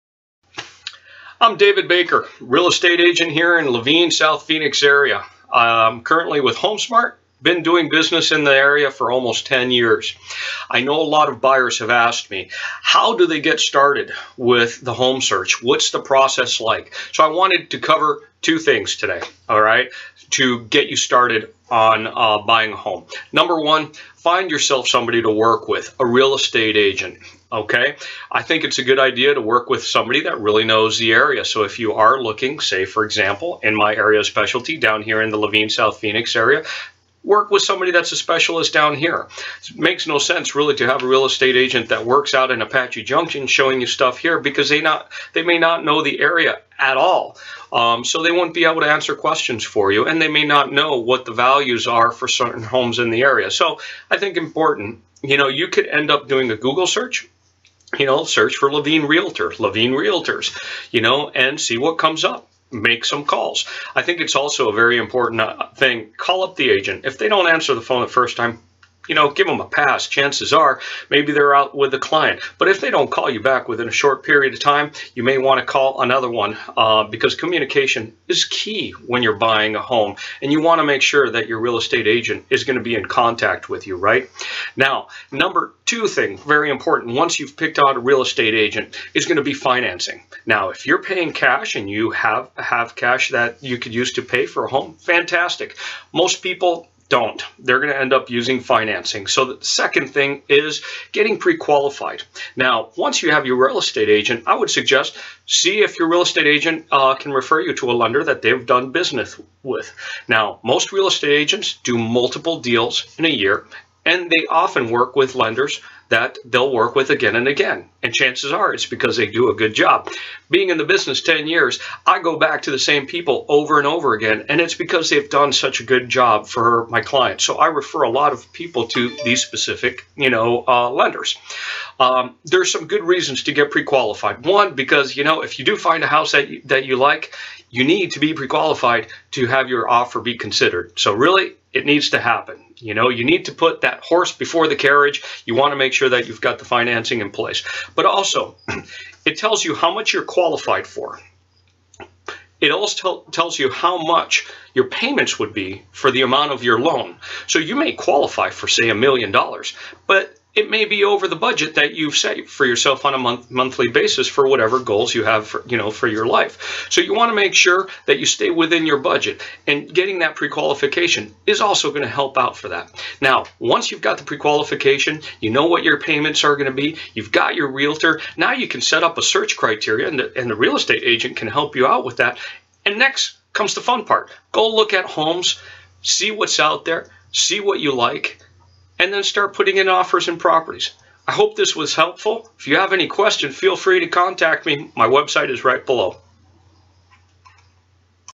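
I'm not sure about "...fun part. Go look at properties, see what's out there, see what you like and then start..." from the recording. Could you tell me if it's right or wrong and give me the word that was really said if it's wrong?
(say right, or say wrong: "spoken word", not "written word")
wrong: "homes", not "properties".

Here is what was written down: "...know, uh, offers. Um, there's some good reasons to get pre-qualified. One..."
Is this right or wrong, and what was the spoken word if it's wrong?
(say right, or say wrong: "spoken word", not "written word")
wrong: "lenders", not "offers".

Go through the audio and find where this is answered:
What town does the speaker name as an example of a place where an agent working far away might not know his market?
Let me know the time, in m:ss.
0:42.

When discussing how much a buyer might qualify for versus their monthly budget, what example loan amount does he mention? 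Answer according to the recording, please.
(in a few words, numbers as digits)
$1,000,000.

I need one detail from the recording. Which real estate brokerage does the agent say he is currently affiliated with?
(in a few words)
HomeSmart.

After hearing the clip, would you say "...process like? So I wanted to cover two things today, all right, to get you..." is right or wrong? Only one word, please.
right.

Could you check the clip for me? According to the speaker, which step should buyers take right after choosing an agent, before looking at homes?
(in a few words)
Getting pre-qualified.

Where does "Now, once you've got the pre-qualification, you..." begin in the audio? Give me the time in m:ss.
2:53.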